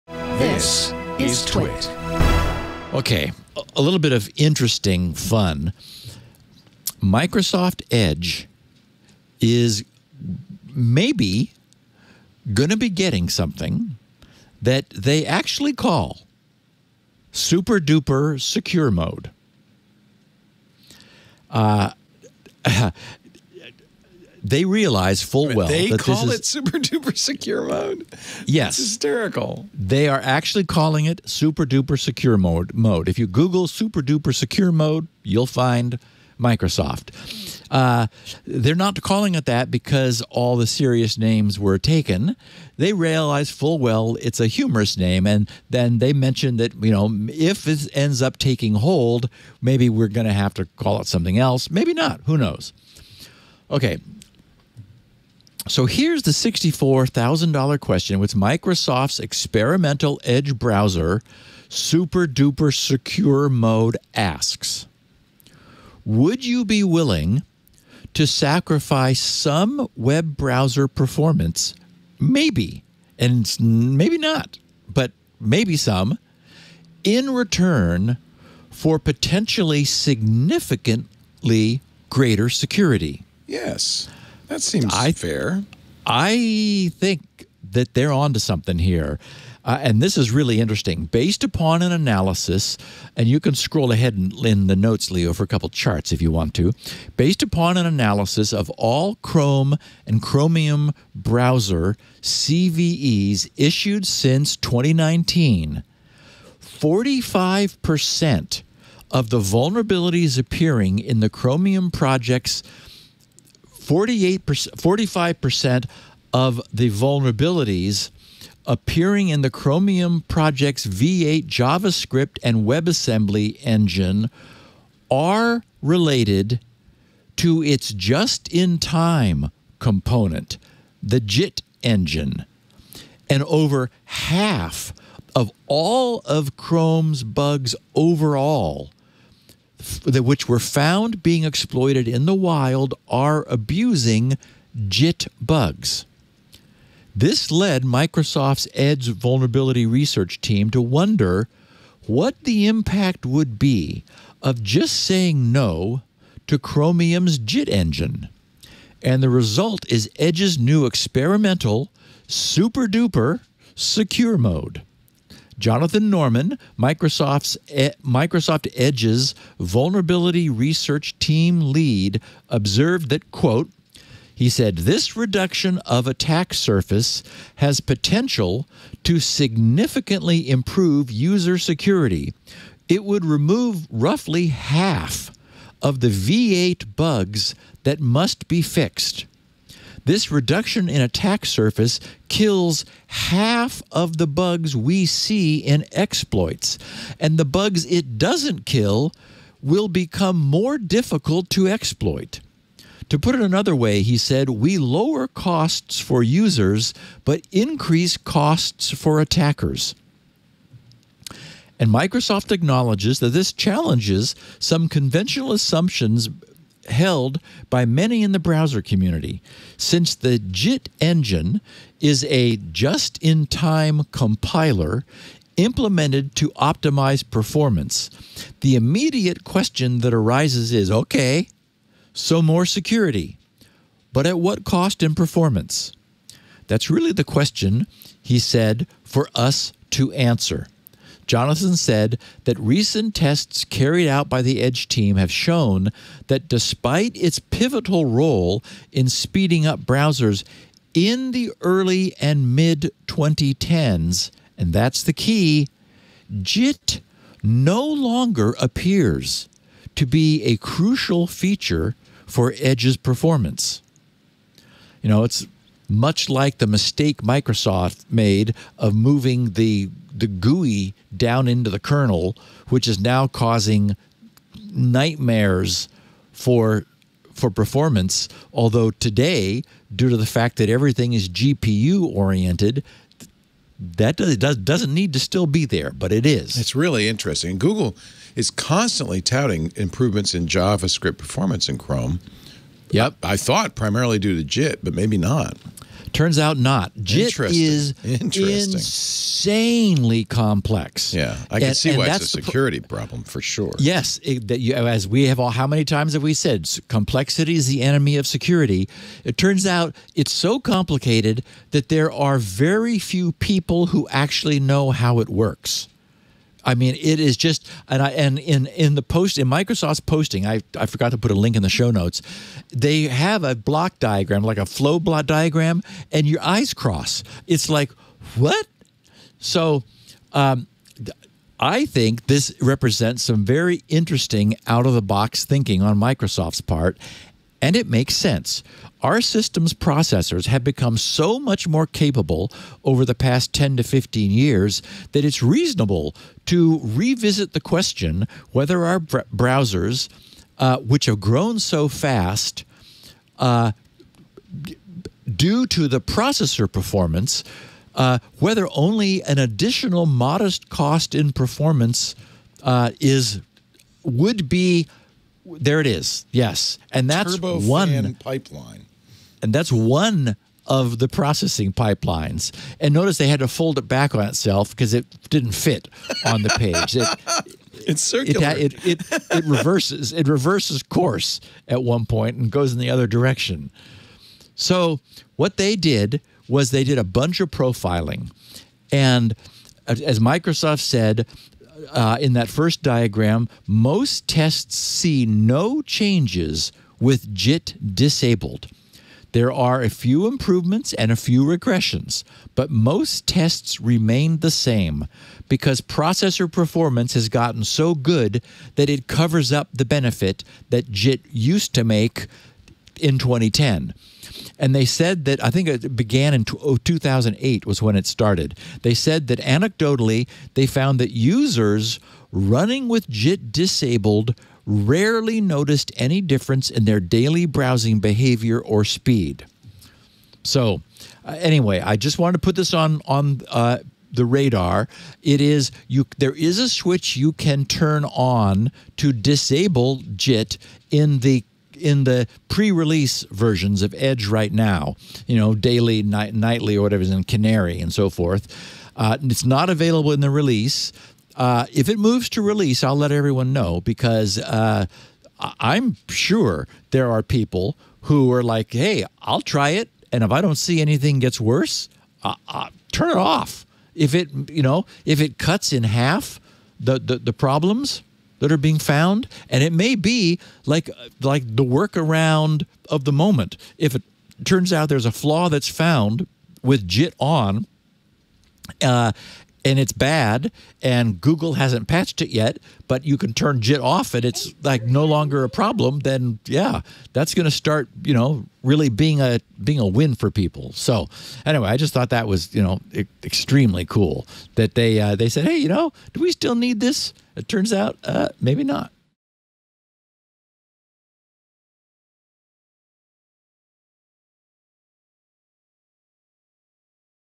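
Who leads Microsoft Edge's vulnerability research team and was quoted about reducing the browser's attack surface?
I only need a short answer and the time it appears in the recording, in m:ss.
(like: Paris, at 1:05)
Jonathan Norman, at 2:45.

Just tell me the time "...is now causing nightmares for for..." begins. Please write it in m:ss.
4:32.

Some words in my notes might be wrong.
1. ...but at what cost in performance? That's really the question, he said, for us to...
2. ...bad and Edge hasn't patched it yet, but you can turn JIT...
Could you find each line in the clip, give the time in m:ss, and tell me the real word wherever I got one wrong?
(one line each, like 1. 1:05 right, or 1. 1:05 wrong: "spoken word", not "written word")
1. 3:54 right
2. 7:59 wrong: "Google", not "Edge".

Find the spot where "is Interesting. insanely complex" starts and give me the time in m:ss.
4:57.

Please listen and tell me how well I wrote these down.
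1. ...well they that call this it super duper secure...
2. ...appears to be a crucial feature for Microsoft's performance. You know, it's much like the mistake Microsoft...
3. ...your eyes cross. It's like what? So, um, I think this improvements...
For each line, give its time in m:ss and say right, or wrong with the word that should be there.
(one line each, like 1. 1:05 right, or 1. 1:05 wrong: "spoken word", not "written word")
1. 0:25 right
2. 4:18 wrong: "Edge", not "Microsoft"
3. 5:26 wrong: "represents", not "improvements".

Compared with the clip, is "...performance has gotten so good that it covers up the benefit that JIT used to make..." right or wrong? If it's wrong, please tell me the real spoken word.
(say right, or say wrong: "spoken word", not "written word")
right.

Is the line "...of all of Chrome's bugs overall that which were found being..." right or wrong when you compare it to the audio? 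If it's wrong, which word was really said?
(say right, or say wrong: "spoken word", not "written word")
right.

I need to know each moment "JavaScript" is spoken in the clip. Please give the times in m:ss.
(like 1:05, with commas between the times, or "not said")
2:01, 4:50.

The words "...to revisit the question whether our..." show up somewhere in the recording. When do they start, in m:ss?
5:46.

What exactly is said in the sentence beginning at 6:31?
Uh, in that first diagram, most tests see no changes with JIT disabled.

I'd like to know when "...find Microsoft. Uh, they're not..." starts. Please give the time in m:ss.
0:35.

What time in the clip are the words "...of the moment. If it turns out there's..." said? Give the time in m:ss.
7:52.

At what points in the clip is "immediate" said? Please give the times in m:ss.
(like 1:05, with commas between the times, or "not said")
3:48.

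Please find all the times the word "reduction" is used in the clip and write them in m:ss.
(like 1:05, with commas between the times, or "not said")
2:55, 3:10.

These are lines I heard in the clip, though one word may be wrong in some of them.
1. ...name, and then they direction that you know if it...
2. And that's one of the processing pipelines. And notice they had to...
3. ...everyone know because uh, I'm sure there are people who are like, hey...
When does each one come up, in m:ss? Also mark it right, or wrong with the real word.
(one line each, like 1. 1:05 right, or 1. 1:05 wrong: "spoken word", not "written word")
1. 0:44 wrong: "mention", not "direction"
2. 6:09 right
3. 7:33 right.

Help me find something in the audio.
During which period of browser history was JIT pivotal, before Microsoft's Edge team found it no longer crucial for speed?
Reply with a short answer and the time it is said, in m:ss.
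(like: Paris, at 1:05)
early and mid 2010s, at 4:11.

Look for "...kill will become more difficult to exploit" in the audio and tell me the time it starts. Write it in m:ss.
3:18.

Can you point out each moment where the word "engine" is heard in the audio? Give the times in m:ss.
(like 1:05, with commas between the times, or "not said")
2:03, 2:11, 2:37, 3:40.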